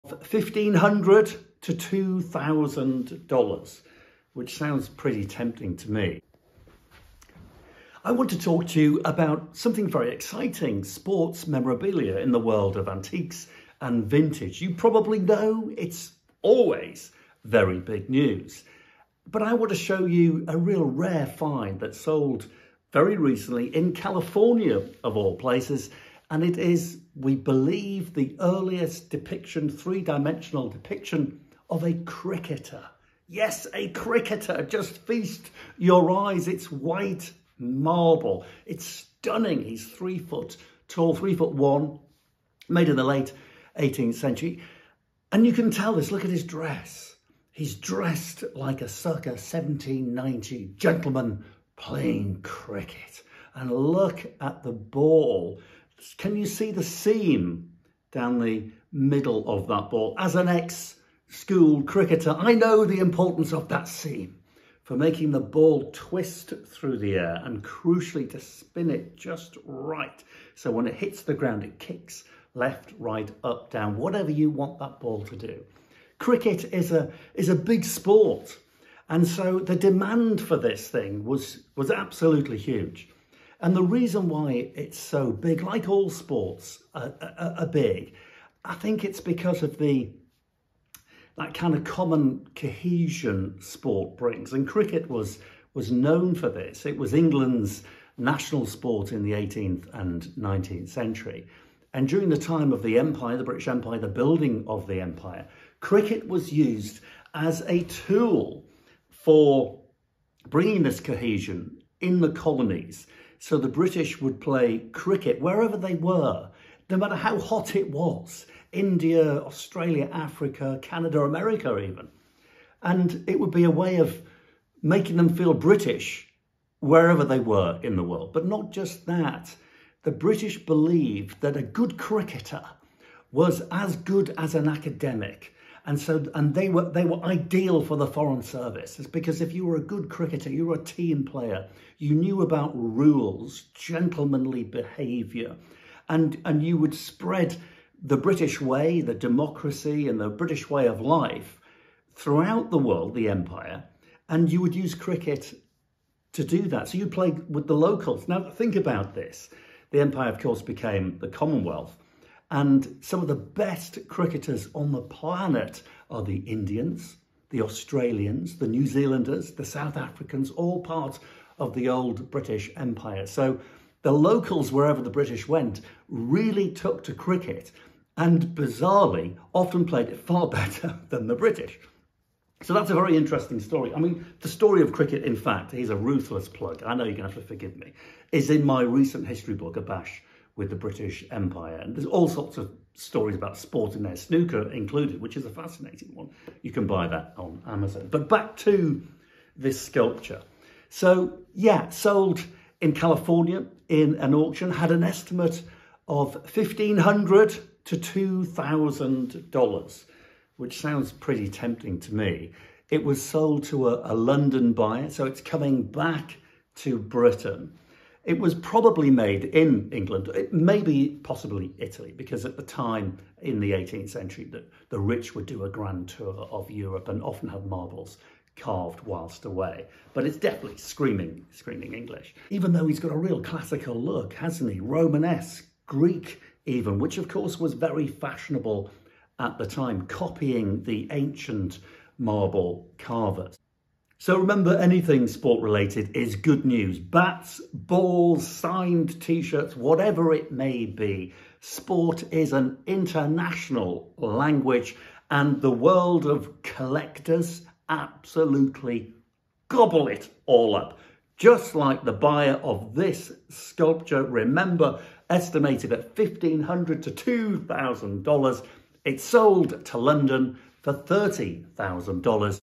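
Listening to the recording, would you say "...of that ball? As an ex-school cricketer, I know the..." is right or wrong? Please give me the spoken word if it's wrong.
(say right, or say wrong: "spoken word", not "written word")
right.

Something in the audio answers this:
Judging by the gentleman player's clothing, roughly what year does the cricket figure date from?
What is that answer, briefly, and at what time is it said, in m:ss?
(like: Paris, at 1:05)
circa 1790, at 0:48.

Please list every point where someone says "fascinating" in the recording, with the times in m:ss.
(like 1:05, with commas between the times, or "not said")
3:15.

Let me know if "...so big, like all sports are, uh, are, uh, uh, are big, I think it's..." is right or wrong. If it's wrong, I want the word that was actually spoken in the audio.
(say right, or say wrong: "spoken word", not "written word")
right.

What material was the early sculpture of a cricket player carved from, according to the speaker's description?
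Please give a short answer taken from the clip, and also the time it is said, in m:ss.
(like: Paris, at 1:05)
White marble, at 0:36.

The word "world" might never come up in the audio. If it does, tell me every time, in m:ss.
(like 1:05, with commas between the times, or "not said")
0:12, 2:08, 2:32, 4:15.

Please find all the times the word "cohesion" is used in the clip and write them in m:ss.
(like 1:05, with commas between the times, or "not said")
1:32, 1:50.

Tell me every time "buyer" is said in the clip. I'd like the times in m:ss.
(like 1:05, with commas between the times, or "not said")
3:34, 4:22.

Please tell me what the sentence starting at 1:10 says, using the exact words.
So when it hits the ground, it kicks left, right, up, down, whatever you want that ball to do.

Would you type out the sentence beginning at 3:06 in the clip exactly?
I know you're going to have to forgive me, is in my recent history book, A Bash, with the British Empire.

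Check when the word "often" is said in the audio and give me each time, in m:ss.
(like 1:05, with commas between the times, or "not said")
2:59, 3:47.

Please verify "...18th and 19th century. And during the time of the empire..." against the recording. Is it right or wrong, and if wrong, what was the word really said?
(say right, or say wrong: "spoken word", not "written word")
right.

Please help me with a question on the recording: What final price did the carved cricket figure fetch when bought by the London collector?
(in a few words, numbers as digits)
$30,000.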